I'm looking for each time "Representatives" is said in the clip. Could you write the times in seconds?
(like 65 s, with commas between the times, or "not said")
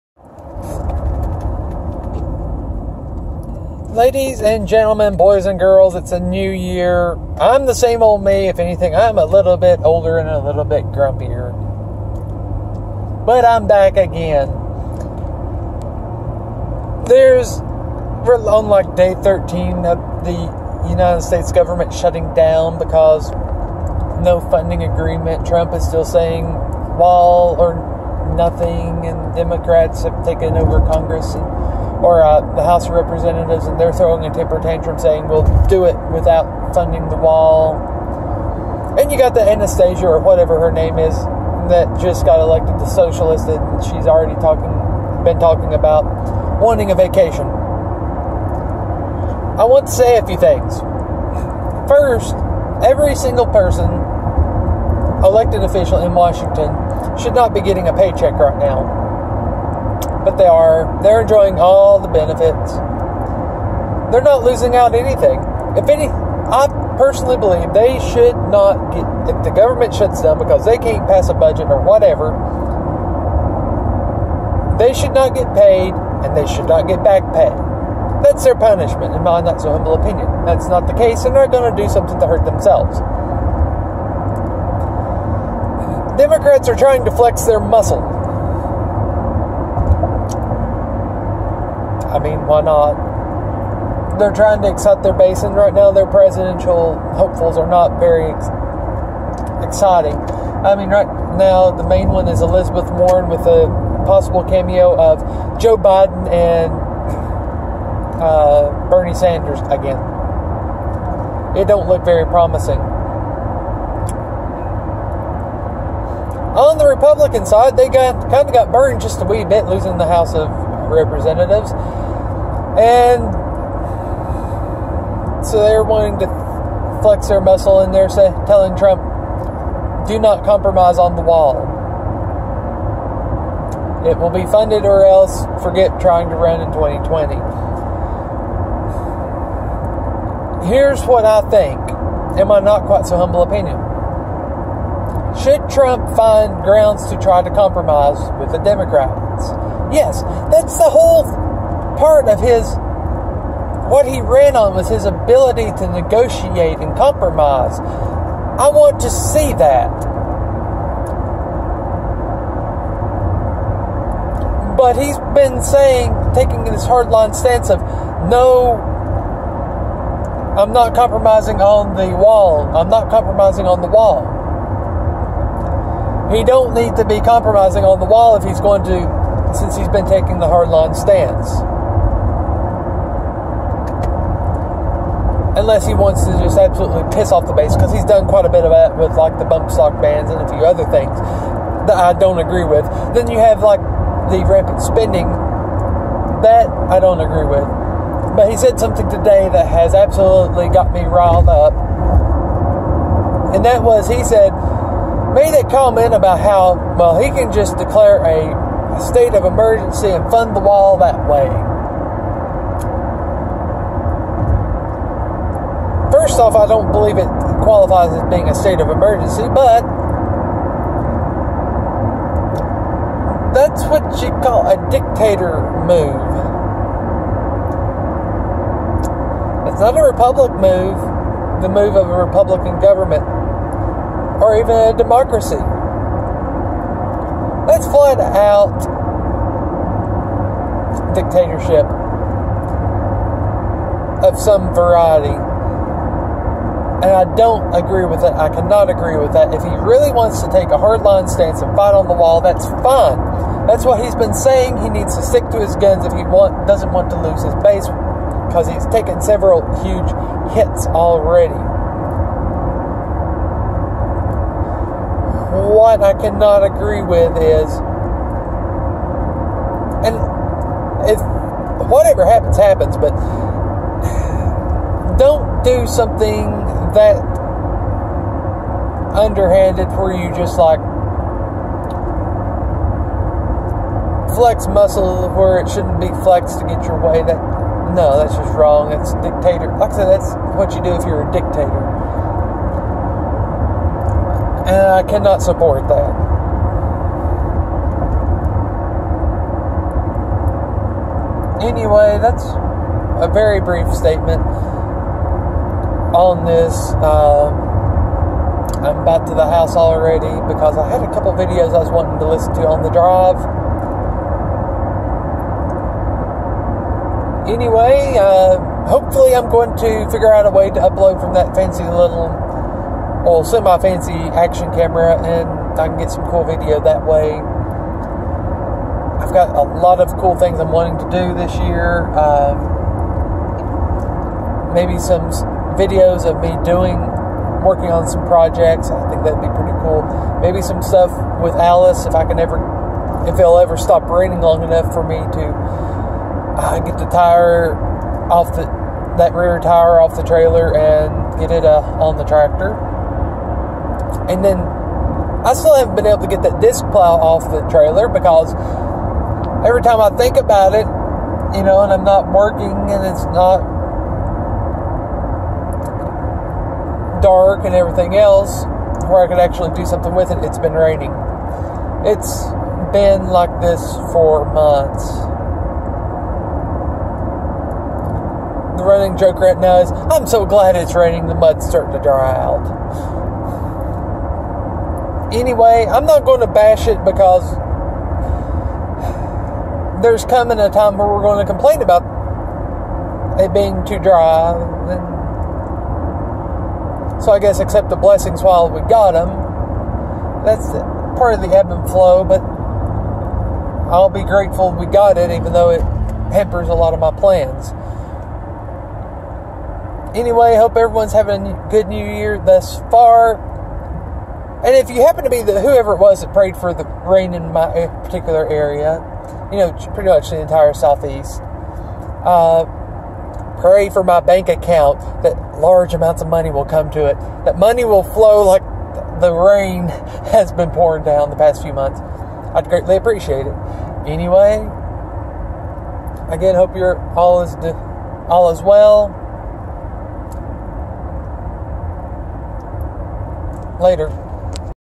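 32 s, 120 s.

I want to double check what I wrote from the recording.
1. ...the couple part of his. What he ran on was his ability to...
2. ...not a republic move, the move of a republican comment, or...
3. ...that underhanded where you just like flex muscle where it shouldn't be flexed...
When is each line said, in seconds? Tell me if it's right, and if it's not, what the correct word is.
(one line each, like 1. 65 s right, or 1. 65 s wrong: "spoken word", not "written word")
1. 150 s wrong: "whole", not "couple"
2. 229 s wrong: "government", not "comment"
3. 276 s right.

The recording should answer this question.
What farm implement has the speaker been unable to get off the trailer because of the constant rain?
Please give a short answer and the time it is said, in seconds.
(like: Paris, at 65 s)
disc plow, at 356 s.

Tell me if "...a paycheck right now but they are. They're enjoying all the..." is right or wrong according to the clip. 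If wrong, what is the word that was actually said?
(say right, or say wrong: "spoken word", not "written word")
right.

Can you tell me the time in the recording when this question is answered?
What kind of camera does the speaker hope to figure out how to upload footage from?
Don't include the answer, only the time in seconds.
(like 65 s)
324 s.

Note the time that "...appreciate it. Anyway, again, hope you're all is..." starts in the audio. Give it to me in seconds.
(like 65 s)
432 s.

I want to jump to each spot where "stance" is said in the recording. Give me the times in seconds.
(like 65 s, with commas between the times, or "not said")
167 s, 180 s, 251 s.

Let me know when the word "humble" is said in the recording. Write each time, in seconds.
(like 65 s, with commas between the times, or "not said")
79 s, 143 s.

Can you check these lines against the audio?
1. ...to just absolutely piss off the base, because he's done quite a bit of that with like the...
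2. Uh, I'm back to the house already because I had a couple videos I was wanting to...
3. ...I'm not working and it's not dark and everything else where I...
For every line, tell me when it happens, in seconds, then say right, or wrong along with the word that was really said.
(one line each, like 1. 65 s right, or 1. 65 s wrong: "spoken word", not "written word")
1. 186 s right
2. 307 s right
3. 361 s right.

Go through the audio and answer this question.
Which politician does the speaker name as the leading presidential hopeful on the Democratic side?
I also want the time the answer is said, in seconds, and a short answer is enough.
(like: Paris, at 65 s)
Elizabeth Warren, at 102 s.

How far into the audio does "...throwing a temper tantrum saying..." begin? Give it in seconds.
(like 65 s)
33 s.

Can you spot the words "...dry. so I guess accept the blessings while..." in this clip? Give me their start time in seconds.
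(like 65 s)
393 s.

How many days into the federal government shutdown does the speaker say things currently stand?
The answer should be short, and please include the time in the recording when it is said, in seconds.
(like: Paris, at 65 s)
13, at 19 s.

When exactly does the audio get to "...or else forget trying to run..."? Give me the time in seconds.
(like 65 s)
134 s.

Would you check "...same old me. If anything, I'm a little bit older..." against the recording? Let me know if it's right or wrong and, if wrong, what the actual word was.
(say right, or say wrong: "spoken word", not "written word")
right.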